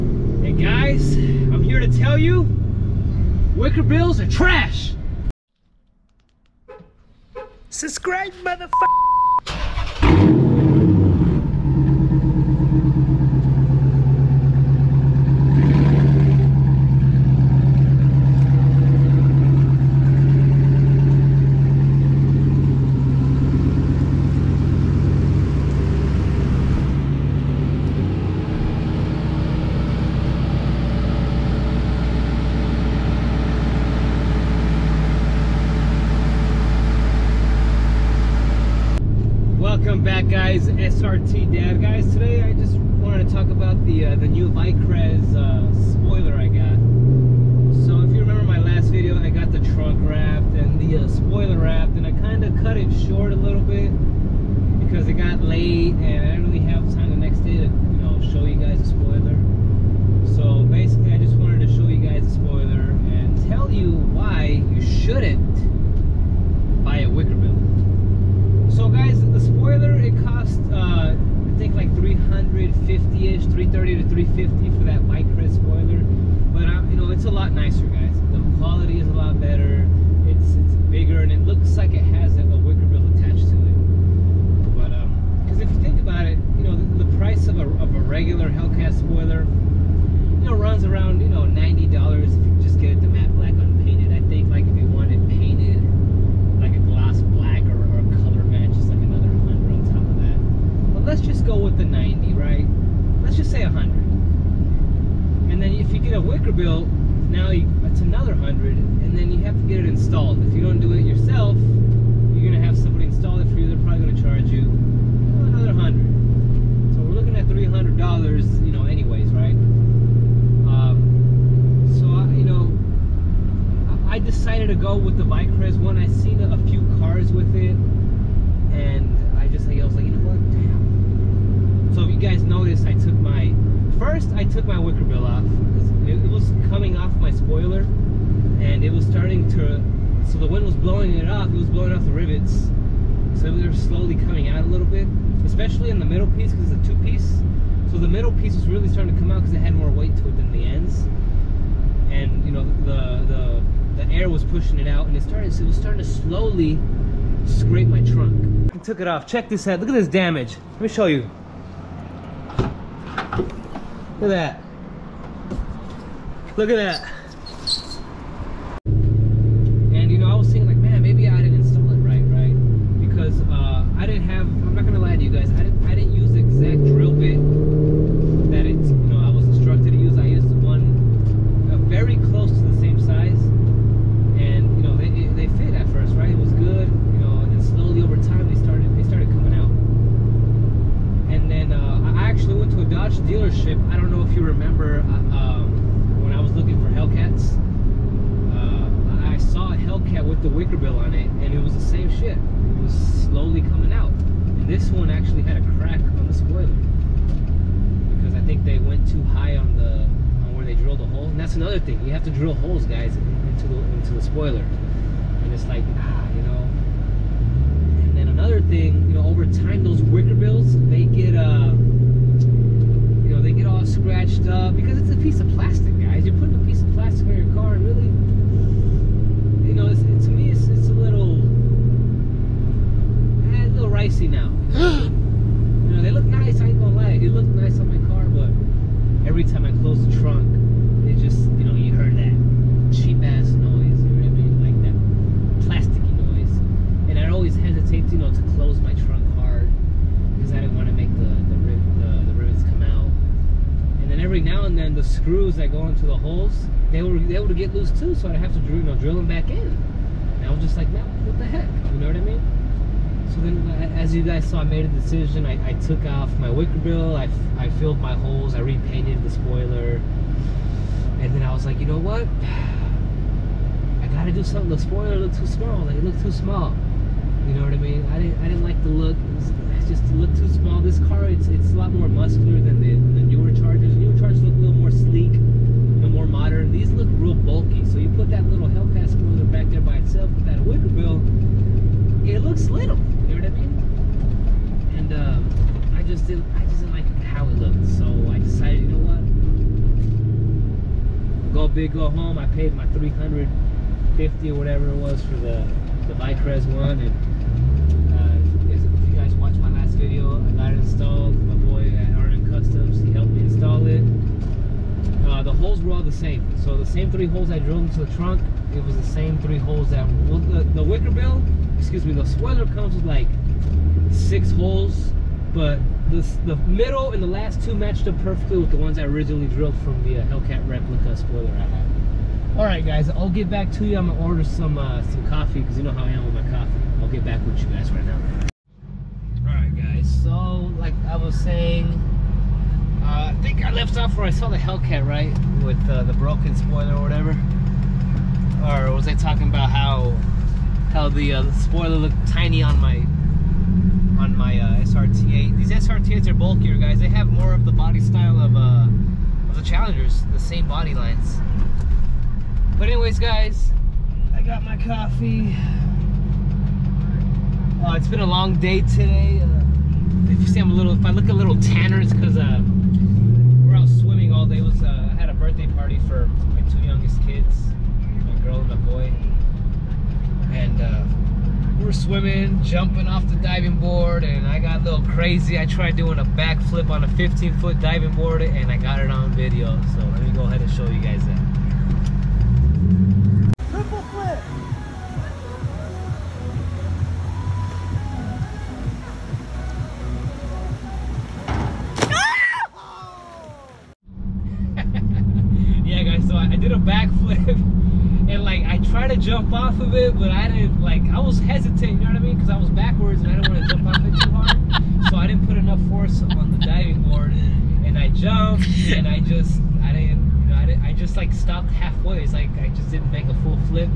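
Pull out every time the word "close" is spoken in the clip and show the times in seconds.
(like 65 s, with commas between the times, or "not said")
239 s, 248 s.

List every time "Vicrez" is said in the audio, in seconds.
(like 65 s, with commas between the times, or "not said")
125 s, 306 s.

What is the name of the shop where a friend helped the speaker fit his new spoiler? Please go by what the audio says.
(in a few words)
RM Customs.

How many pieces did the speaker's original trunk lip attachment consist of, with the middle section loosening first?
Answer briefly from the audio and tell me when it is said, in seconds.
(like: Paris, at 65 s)
2, at 146 s.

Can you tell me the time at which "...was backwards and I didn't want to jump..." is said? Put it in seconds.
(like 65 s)
412 s.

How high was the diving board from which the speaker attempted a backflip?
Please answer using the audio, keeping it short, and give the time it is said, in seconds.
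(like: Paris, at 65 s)
15 feet, at 387 s.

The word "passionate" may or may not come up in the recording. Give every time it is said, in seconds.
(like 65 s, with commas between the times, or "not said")
not said.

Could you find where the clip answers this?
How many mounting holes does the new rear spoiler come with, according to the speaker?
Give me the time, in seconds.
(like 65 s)
324 s.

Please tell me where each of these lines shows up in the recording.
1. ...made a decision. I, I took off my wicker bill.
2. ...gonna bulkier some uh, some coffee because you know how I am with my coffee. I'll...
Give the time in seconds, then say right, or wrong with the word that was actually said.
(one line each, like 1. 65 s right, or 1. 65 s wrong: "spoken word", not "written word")
1. 264 s right
2. 334 s wrong: "order", not "bulkier".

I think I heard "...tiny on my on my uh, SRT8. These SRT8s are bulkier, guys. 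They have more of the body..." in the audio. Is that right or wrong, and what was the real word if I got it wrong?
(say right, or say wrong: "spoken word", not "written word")
right.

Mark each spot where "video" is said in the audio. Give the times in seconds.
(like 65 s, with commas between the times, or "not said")
309 s, 389 s.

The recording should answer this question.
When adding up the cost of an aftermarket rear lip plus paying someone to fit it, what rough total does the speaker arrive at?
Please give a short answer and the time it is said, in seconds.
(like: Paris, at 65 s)
$300, at 117 s.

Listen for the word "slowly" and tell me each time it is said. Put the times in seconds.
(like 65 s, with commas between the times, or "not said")
143 s, 156 s, 203 s.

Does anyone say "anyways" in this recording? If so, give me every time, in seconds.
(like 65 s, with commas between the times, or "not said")
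118 s, 362 s.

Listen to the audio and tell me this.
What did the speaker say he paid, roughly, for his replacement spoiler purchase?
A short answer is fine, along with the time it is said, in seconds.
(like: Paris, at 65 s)
$350, at 302 s.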